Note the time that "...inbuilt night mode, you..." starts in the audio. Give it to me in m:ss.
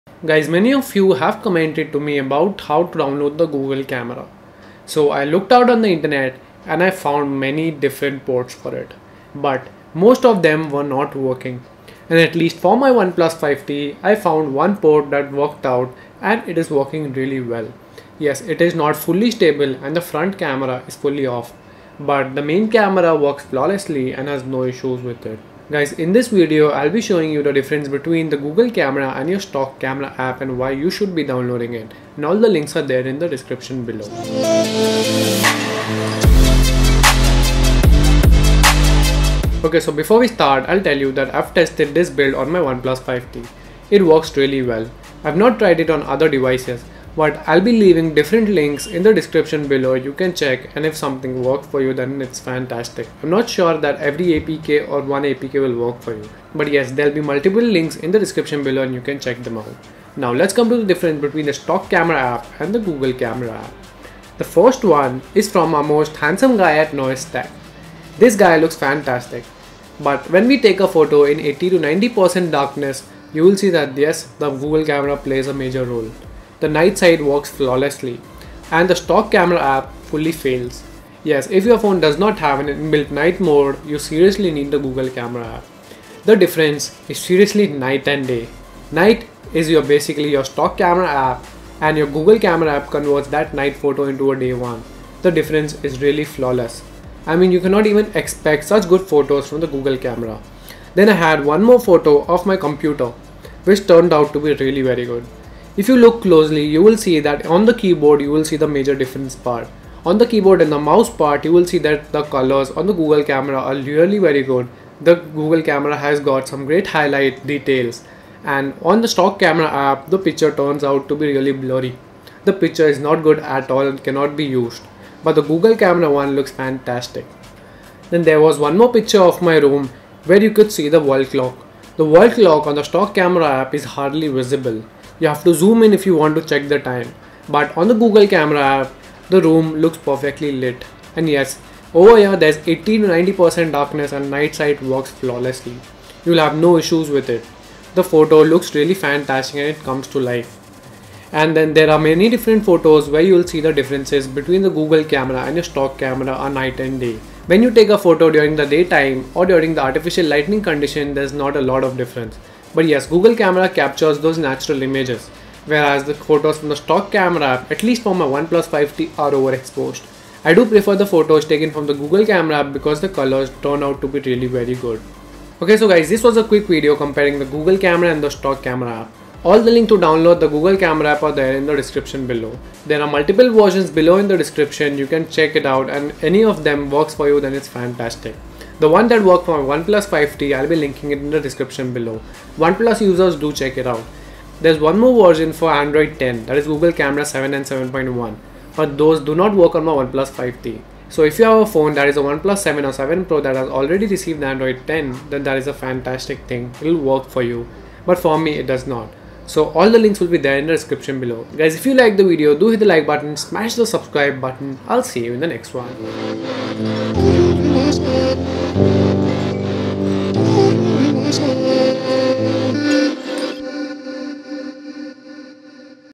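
1:22.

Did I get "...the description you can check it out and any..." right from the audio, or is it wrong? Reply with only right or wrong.
right.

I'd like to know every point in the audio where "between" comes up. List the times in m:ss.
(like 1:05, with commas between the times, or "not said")
0:27, 1:01, 2:34.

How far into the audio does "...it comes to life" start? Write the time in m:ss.
2:29.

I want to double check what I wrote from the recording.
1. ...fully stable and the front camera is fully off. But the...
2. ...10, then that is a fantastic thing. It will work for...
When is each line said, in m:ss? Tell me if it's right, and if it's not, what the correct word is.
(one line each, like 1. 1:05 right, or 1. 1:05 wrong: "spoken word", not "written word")
1. 0:18 right
2. 3:24 right.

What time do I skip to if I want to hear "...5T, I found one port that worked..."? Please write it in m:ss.
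0:13.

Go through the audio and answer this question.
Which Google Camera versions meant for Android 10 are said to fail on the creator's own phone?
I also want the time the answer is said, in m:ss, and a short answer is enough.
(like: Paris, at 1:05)
7 and 7.1, at 3:16.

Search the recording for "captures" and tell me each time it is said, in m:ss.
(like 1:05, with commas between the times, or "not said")
2:43.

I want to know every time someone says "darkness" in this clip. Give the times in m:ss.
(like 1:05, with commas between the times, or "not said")
1:12, 2:23.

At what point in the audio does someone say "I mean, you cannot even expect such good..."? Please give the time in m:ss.
1:37.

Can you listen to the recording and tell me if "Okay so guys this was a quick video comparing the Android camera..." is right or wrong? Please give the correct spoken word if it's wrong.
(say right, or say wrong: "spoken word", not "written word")
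wrong: "Google", not "Android".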